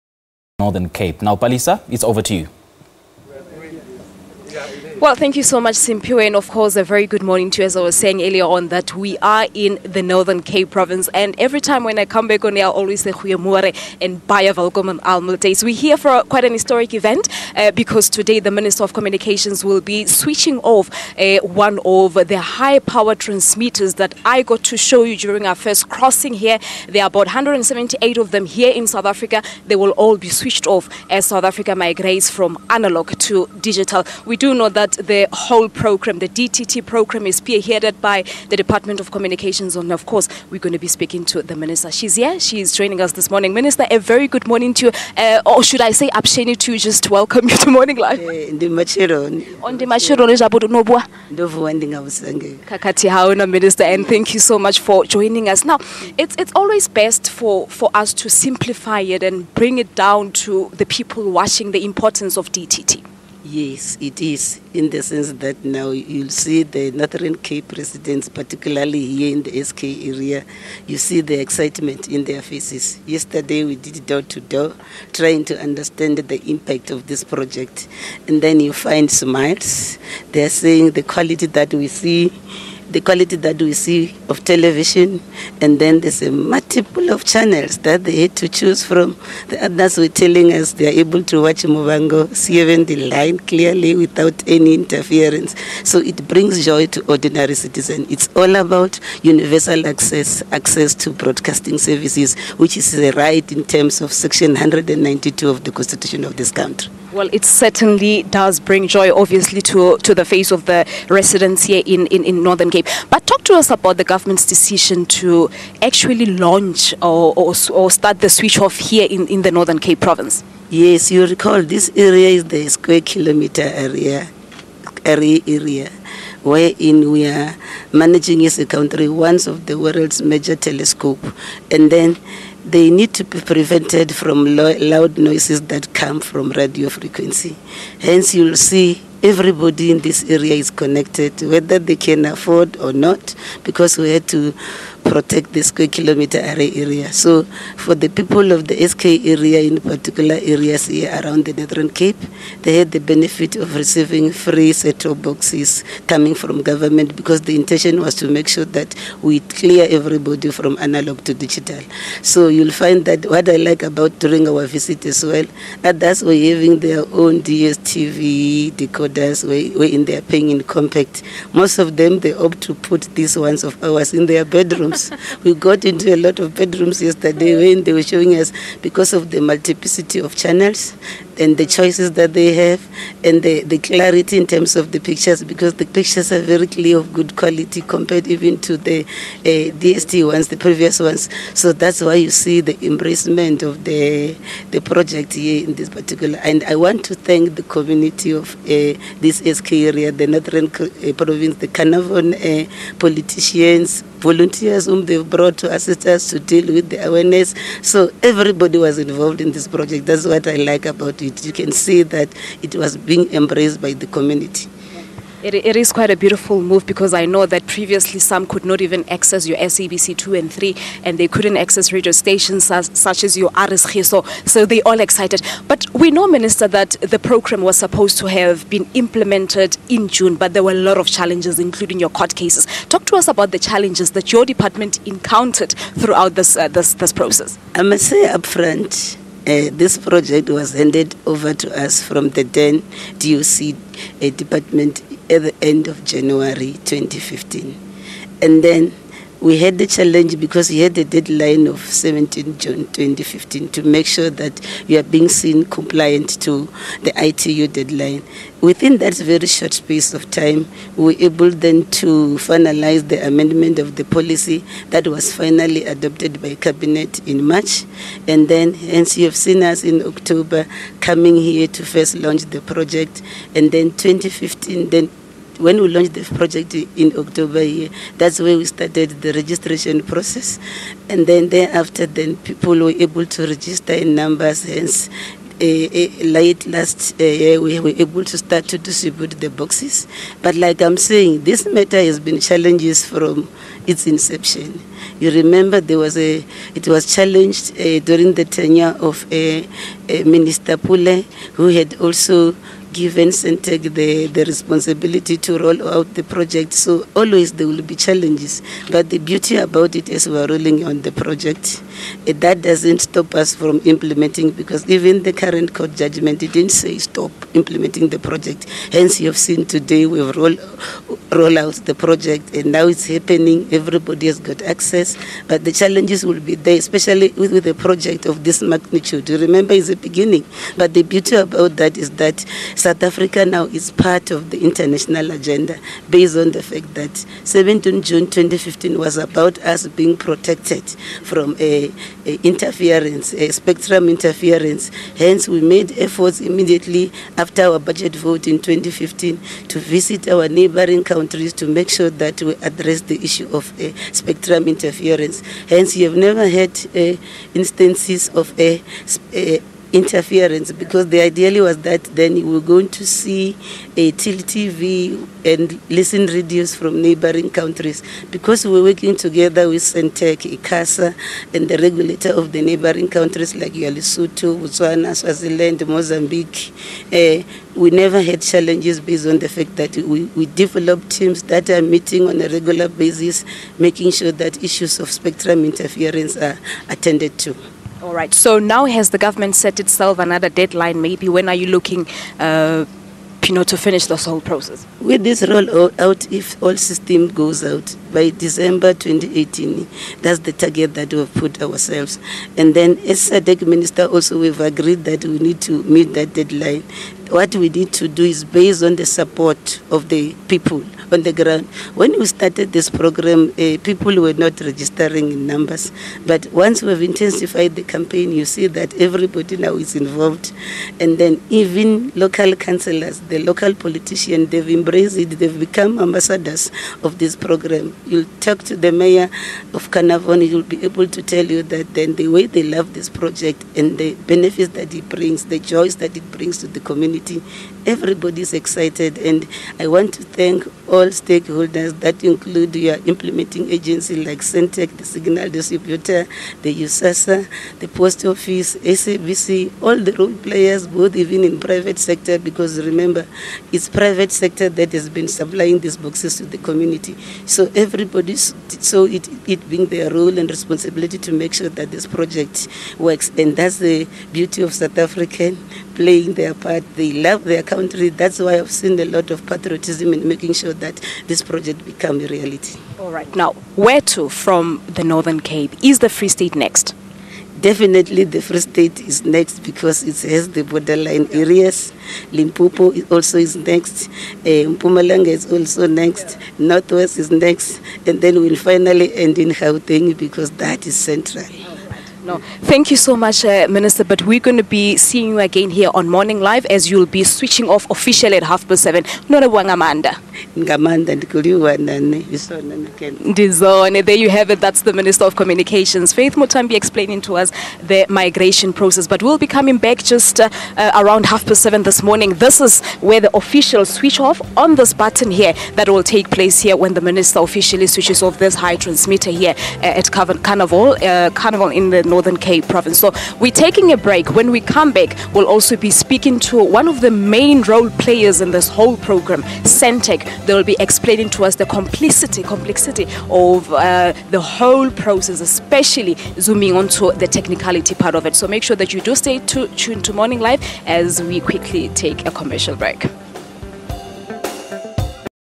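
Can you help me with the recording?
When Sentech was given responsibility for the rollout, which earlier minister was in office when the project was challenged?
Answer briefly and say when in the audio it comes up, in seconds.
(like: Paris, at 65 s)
Minister Pule, at 300 s.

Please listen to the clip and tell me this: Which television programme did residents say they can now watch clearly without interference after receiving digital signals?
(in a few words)
Muvhango.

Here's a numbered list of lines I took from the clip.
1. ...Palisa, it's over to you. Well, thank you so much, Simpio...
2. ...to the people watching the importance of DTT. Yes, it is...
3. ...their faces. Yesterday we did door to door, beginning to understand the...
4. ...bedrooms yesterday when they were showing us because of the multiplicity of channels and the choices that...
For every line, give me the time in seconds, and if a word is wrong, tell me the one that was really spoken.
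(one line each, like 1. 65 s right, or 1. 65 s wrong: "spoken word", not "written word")
1. 1 s right
2. 60 s right
3. 72 s wrong: "trying", not "beginning"
4. 176 s right.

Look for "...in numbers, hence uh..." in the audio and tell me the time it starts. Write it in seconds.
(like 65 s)
283 s.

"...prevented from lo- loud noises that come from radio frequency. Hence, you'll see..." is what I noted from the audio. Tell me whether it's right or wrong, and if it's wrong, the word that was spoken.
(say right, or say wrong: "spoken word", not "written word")
right.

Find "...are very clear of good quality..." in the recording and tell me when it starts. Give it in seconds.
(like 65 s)
186 s.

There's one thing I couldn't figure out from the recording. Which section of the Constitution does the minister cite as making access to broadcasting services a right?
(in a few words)
Section 192.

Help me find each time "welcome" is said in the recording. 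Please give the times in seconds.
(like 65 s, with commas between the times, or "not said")
14 s, 47 s.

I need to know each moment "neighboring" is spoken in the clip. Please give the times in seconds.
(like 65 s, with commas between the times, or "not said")
350 s, 367 s, 372 s.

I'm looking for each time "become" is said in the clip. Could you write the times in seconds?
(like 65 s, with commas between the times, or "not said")
425 s, 471 s.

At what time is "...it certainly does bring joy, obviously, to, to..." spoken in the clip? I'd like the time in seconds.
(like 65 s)
107 s.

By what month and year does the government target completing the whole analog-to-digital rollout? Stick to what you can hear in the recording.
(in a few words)
December 2018.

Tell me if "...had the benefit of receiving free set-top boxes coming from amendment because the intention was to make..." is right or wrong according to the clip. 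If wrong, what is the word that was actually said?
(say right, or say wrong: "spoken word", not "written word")
wrong: "government", not "amendment".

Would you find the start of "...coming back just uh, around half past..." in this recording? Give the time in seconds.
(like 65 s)
509 s.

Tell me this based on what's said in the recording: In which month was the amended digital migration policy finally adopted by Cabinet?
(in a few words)
March.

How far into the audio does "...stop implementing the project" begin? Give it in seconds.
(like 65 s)
316 s.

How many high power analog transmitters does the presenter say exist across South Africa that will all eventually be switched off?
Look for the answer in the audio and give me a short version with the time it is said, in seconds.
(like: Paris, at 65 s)
178, at 27 s.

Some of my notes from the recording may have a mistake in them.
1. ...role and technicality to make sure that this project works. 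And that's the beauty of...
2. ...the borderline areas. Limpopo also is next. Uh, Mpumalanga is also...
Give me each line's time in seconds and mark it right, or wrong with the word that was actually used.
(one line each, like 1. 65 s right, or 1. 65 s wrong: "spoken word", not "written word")
1. 460 s wrong: "responsibility", not "technicality"
2. 480 s right.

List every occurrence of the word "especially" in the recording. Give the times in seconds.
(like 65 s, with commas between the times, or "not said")
326 s, 535 s.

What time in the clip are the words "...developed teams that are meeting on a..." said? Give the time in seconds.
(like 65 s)
380 s.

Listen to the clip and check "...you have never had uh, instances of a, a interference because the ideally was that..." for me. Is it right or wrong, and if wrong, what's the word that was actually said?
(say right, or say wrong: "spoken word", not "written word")
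right.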